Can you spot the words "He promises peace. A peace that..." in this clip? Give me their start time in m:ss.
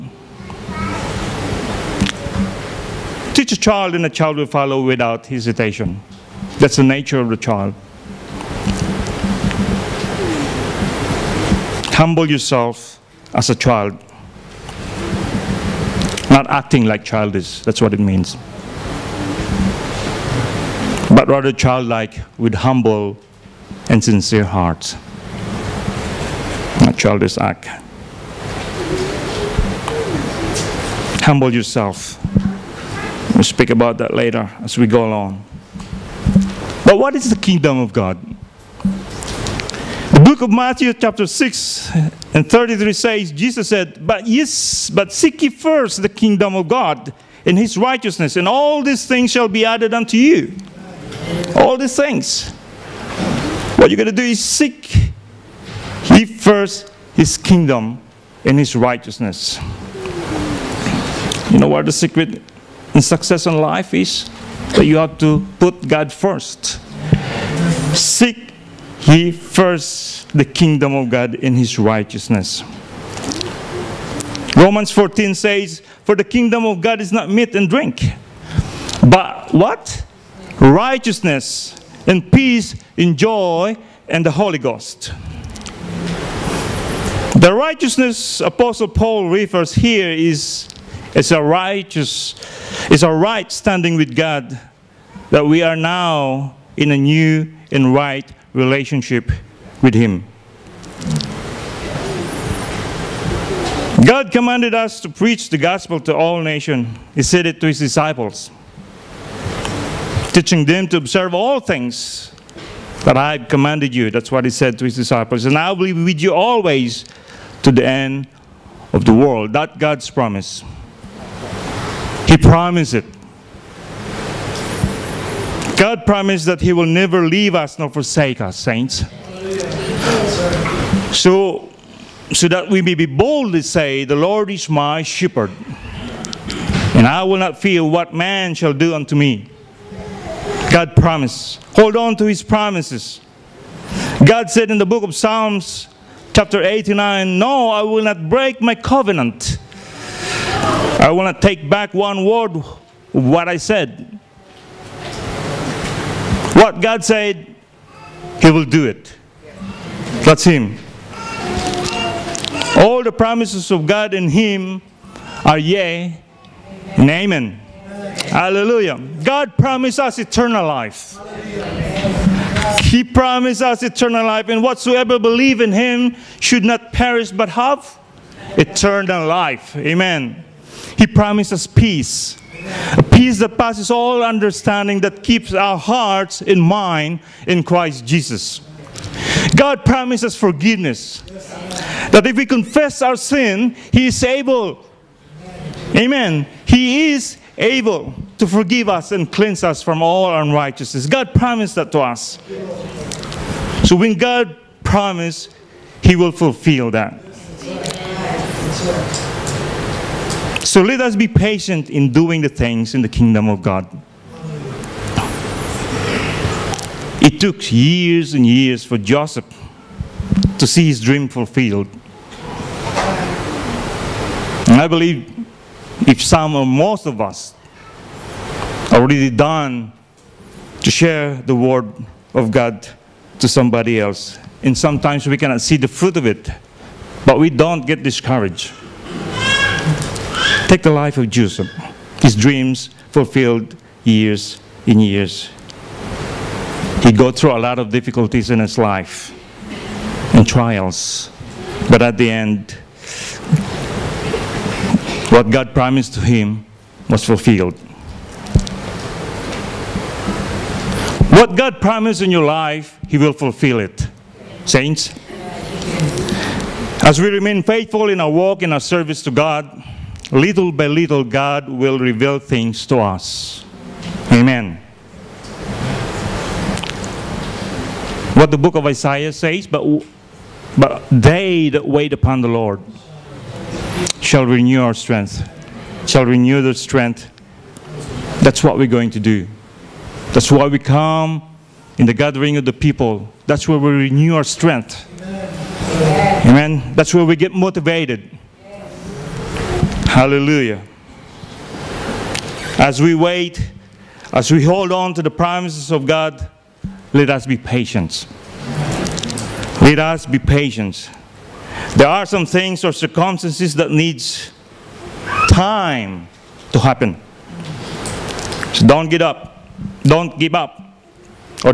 3:00.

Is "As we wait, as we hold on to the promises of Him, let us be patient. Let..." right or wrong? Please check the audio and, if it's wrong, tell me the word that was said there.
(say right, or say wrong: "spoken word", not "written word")
wrong: "God", not "Him".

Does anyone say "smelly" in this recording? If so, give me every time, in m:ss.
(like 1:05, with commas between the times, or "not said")
not said.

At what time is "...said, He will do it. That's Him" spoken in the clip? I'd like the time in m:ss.
2:37.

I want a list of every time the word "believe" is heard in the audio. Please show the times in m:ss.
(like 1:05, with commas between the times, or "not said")
2:55, 3:44.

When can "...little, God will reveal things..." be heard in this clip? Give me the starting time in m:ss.
4:30.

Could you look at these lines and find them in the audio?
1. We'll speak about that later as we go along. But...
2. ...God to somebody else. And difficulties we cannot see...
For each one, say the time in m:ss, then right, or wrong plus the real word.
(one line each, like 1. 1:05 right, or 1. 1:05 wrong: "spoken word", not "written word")
1. 0:33 right
2. 3:52 wrong: "sometimes", not "difficulties".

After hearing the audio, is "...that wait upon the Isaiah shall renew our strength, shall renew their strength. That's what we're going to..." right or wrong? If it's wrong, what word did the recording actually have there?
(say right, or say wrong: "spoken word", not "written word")
wrong: "Lord", not "Isaiah".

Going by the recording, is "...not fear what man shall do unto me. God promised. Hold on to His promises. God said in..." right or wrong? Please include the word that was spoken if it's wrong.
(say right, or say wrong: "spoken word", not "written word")
right.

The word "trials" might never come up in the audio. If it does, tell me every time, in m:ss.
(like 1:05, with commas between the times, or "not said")
4:10.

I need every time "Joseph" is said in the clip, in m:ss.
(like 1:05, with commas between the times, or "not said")
3:38, 4:01.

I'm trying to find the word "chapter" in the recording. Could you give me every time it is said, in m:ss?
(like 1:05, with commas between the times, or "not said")
0:40, 2:26.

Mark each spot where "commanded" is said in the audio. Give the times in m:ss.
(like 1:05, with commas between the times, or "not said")
1:44, 1:53.